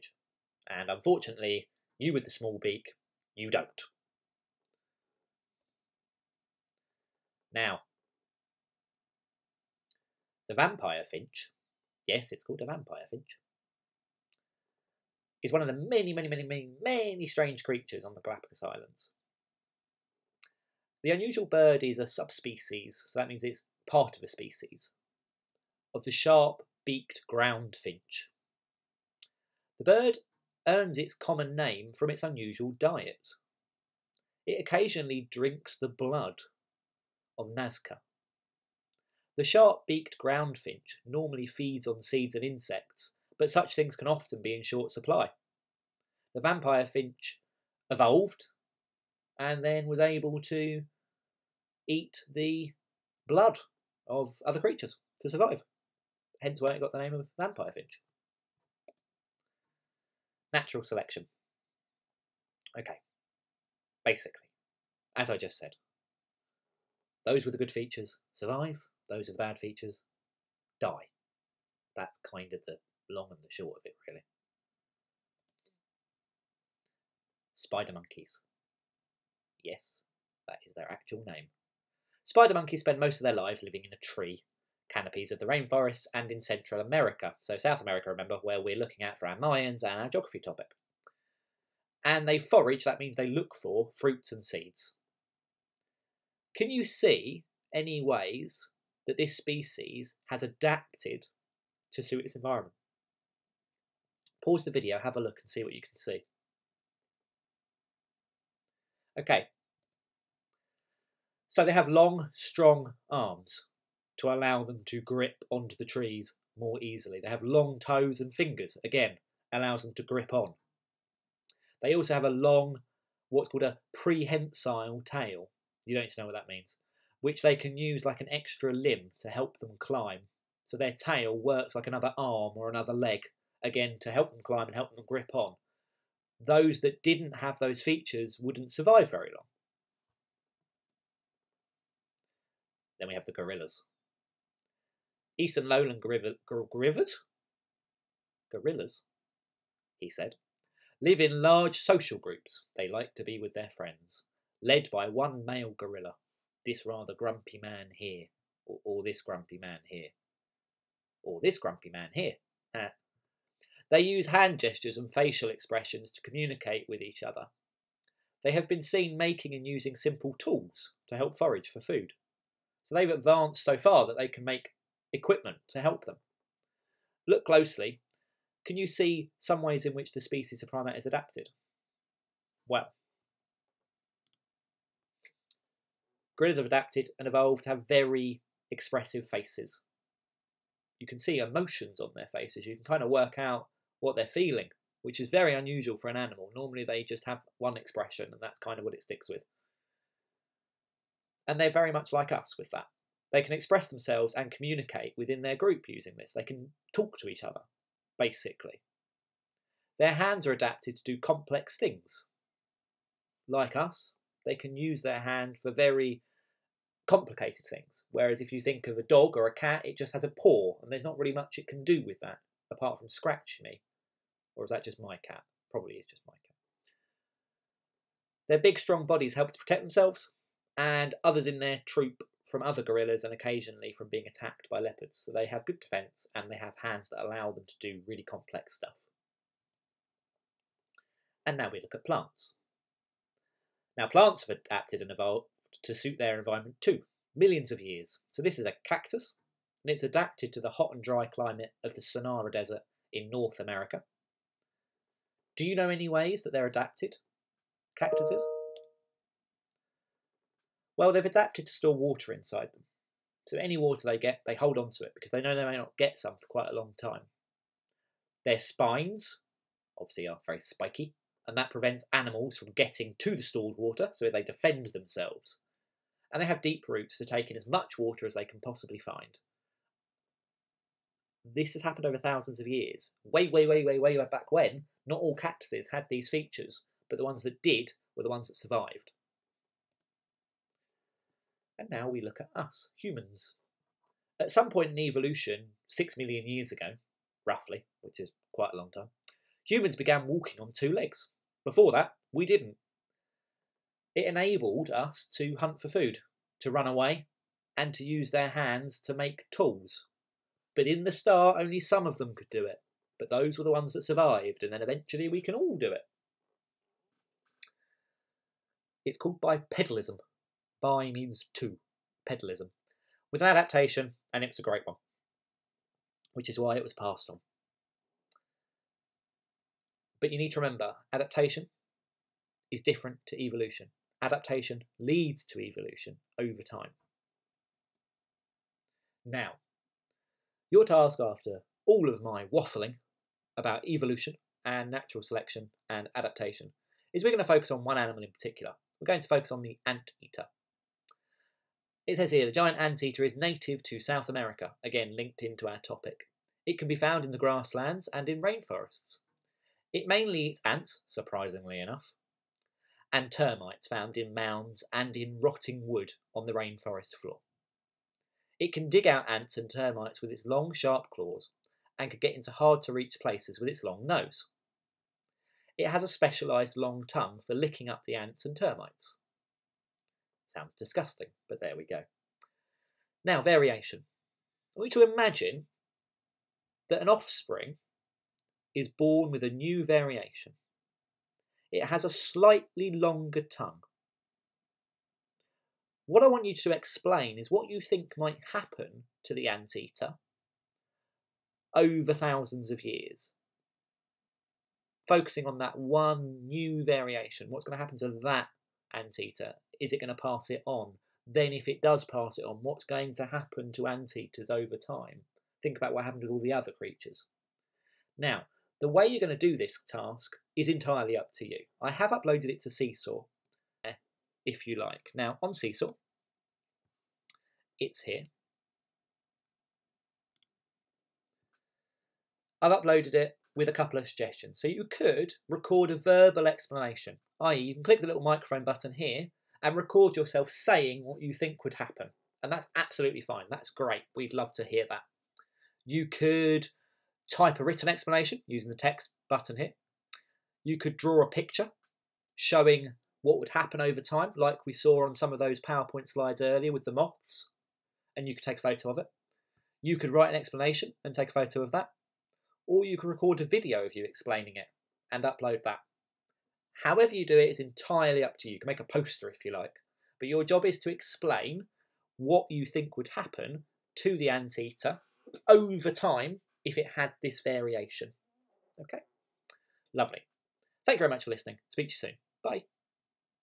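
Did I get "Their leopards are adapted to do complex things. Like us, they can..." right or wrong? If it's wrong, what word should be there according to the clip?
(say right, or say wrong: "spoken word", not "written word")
wrong: "hands", not "leopards".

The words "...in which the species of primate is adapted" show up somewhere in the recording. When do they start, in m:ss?
2:59.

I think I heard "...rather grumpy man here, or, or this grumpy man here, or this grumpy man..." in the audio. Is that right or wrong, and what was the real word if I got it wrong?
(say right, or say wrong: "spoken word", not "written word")
right.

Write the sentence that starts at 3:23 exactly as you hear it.
They can express themselves and communicate within their group using this.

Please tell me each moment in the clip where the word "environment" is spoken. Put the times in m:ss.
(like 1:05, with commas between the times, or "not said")
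1:42, 4:06.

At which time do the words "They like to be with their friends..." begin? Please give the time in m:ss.
2:32.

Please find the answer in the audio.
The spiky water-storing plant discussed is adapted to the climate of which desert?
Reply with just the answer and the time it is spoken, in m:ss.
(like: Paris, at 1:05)
Sonora Desert, at 4:12.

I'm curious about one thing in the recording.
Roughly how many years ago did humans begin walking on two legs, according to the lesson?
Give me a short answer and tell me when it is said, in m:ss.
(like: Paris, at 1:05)
6 million, at 4:55.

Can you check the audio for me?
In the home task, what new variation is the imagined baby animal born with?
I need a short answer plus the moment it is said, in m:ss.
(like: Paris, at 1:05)
a slightly longer tongue, at 6:32.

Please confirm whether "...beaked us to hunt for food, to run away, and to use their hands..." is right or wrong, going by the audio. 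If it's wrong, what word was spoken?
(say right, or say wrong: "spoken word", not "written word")
wrong: "enabled", not "beaked".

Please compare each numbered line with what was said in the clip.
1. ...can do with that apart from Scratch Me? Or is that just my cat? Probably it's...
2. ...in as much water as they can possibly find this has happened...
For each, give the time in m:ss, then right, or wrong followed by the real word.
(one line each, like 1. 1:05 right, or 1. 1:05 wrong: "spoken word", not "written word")
1. 3:41 right
2. 4:37 right.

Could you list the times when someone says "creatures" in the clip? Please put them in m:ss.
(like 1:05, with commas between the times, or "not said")
0:17, 0:54, 6:56.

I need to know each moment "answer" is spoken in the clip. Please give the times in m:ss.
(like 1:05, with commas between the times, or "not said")
not said.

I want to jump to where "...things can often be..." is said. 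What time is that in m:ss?
0:43.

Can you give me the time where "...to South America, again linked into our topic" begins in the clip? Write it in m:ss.
5:53.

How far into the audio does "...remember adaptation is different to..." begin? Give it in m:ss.
5:30.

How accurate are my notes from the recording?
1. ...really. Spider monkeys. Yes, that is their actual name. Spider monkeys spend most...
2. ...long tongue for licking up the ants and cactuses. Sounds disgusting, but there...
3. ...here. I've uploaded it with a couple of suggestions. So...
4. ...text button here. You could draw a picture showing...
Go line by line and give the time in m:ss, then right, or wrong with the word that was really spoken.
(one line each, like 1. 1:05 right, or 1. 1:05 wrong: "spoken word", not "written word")
1. 1:14 right
2. 6:16 wrong: "termites", not "cactuses"
3. 7:08 right
4. 7:28 right.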